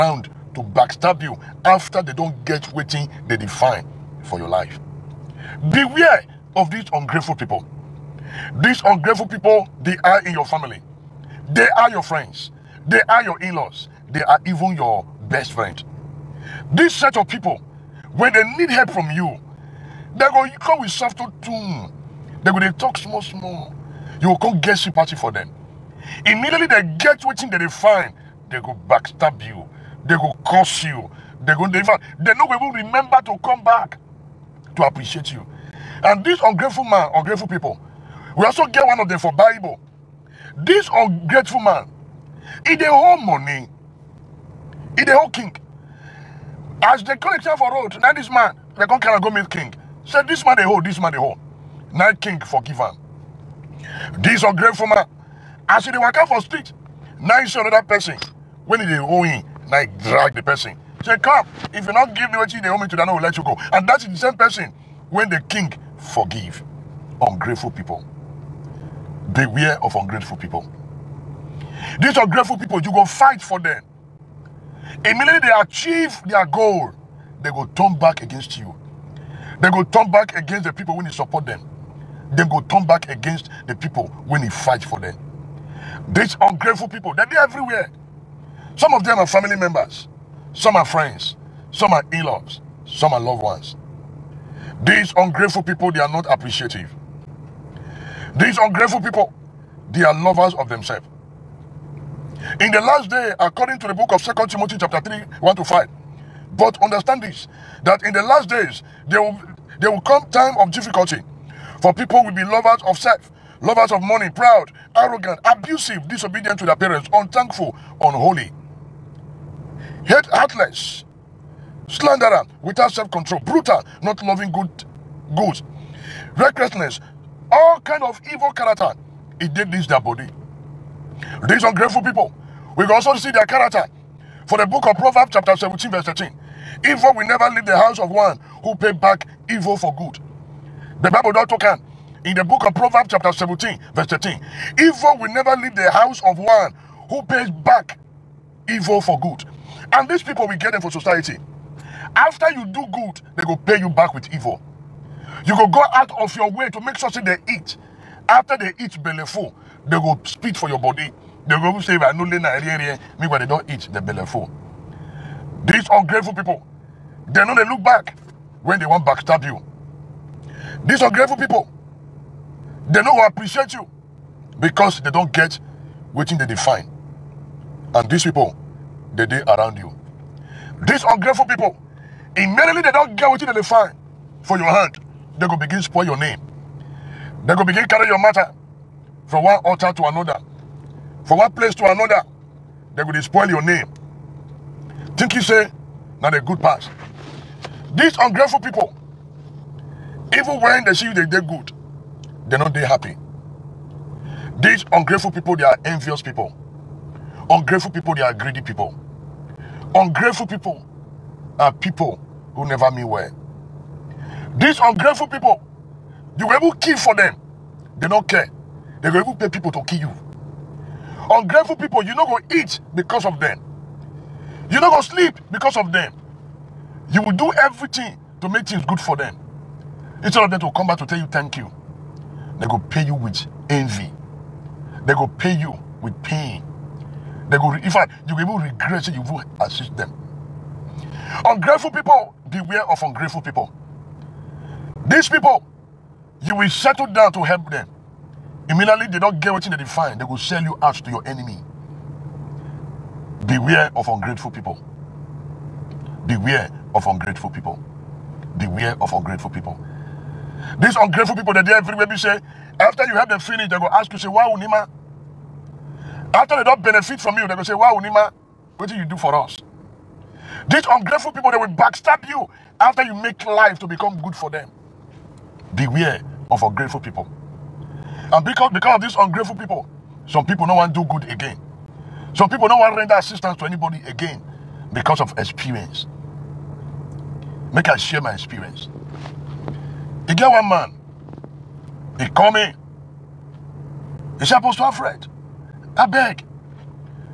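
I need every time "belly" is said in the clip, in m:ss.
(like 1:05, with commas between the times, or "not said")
2:39, 2:43.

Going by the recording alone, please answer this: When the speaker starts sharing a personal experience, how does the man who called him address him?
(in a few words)
Apostle Alfred.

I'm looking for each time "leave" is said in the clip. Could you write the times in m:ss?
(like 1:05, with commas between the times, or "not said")
2:17, 2:25.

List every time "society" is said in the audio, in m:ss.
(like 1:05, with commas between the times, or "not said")
2:30.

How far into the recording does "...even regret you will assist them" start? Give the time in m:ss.
3:58.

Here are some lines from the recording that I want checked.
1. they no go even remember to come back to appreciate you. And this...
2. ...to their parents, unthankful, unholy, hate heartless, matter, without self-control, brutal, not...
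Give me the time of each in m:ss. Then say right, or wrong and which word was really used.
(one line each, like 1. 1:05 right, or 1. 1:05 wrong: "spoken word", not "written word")
1. 0:32 right
2. 1:56 wrong: "slanderer", not "matter".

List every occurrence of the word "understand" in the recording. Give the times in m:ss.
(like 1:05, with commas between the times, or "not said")
1:46.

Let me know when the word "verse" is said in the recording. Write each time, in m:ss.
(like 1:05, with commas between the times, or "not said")
2:15, 2:23.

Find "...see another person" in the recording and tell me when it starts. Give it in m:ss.
0:57.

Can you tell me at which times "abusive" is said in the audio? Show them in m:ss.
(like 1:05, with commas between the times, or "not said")
1:55.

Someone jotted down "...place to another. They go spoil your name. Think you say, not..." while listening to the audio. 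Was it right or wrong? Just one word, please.
right.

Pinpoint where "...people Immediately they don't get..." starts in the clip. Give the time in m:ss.
3:01.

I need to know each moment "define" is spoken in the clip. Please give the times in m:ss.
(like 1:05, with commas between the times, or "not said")
0:03, 2:56, 4:09.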